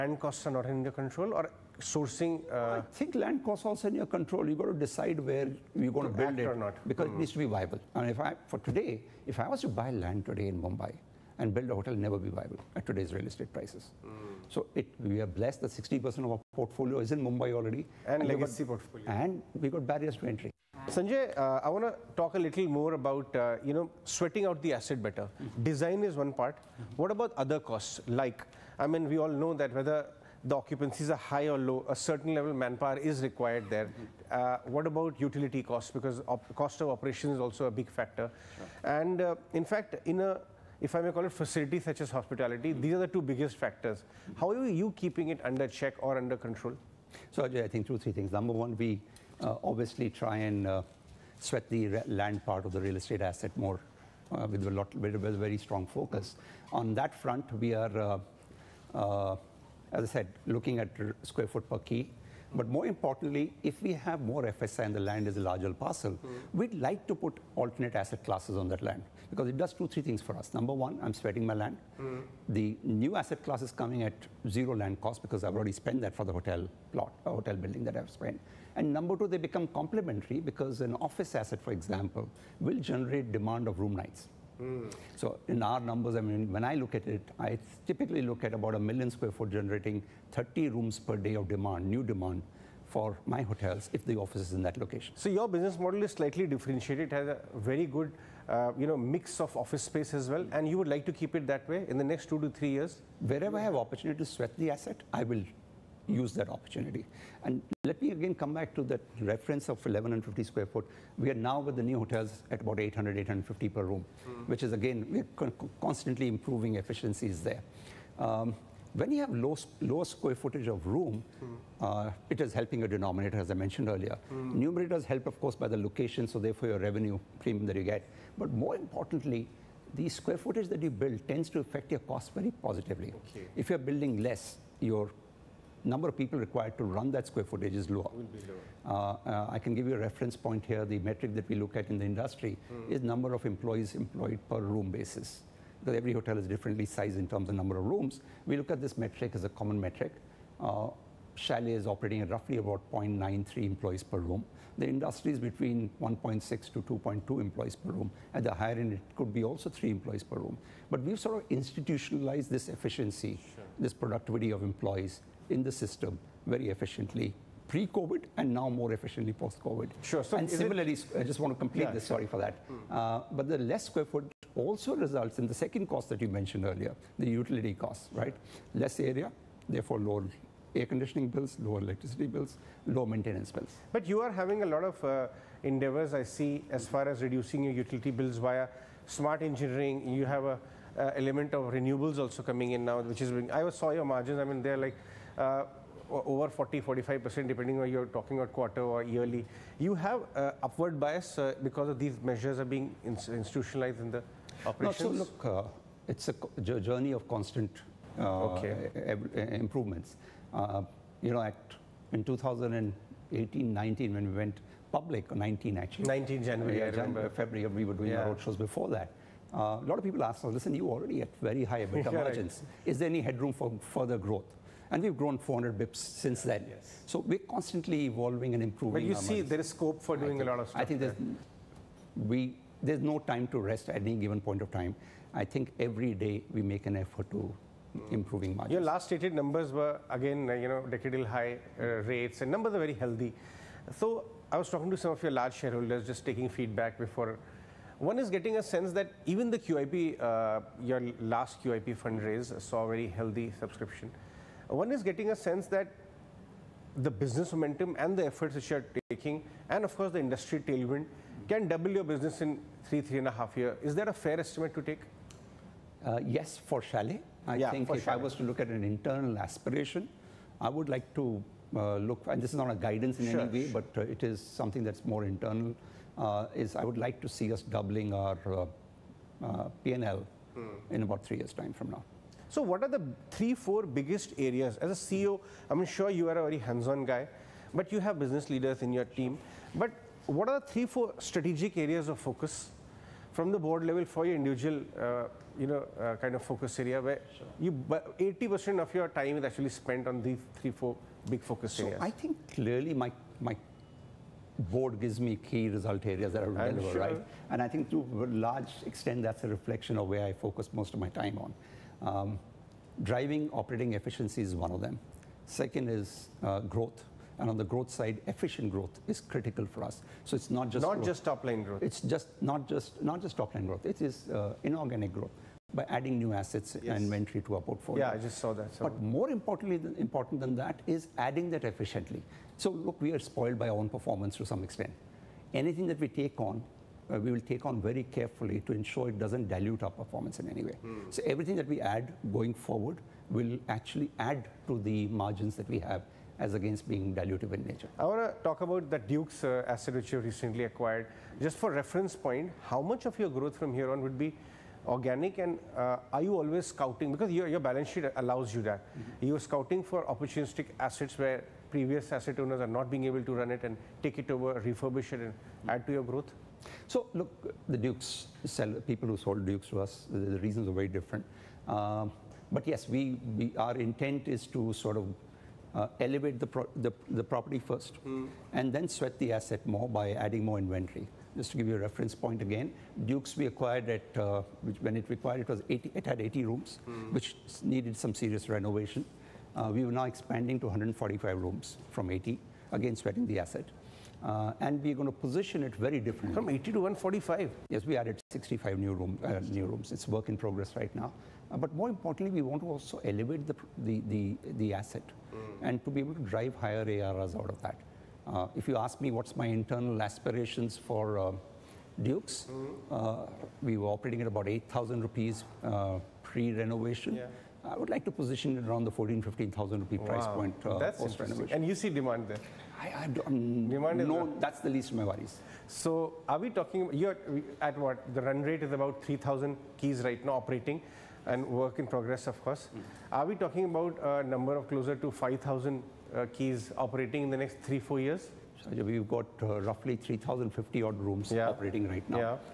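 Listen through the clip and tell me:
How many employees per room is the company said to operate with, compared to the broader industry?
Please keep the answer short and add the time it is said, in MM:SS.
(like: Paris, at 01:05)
0.93, at 02:32.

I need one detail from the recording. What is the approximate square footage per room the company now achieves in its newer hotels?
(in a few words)
800, 850.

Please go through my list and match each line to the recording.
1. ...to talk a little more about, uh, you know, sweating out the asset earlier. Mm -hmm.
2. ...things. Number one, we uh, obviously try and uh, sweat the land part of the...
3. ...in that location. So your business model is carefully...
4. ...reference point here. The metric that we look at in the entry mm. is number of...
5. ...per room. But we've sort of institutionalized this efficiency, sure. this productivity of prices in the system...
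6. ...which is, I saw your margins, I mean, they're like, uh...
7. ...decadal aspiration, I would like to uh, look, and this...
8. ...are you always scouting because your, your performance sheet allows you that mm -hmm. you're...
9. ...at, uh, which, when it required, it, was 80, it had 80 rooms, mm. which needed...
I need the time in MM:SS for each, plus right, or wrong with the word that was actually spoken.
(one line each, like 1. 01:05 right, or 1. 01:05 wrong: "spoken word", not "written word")
1. 00:21 wrong: "better", not "earlier"
2. 00:48 right
3. 01:34 wrong: "slightly", not "carefully"
4. 02:19 wrong: "industry", not "entry"
5. 02:40 wrong: "employees", not "prices"
6. 03:13 right
7. 04:28 wrong: "internal", not "decadal"
8. 05:56 wrong: "balance", not "performance"
9. 06:23 right.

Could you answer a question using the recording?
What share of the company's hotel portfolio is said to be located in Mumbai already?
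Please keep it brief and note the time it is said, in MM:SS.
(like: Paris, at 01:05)
60%, at 00:15.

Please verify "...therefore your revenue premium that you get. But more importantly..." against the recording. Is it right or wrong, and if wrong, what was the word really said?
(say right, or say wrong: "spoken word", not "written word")
right.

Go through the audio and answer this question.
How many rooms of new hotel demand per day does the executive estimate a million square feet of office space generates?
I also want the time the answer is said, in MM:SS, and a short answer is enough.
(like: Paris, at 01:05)
30 rooms, at 01:30.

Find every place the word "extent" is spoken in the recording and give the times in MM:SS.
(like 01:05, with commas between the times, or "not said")
05:08, 05:34.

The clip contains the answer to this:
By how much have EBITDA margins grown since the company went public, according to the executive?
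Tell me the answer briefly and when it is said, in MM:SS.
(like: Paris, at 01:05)
400 bips, at 03:45.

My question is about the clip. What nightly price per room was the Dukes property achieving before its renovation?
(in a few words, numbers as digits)
8,000 rupees.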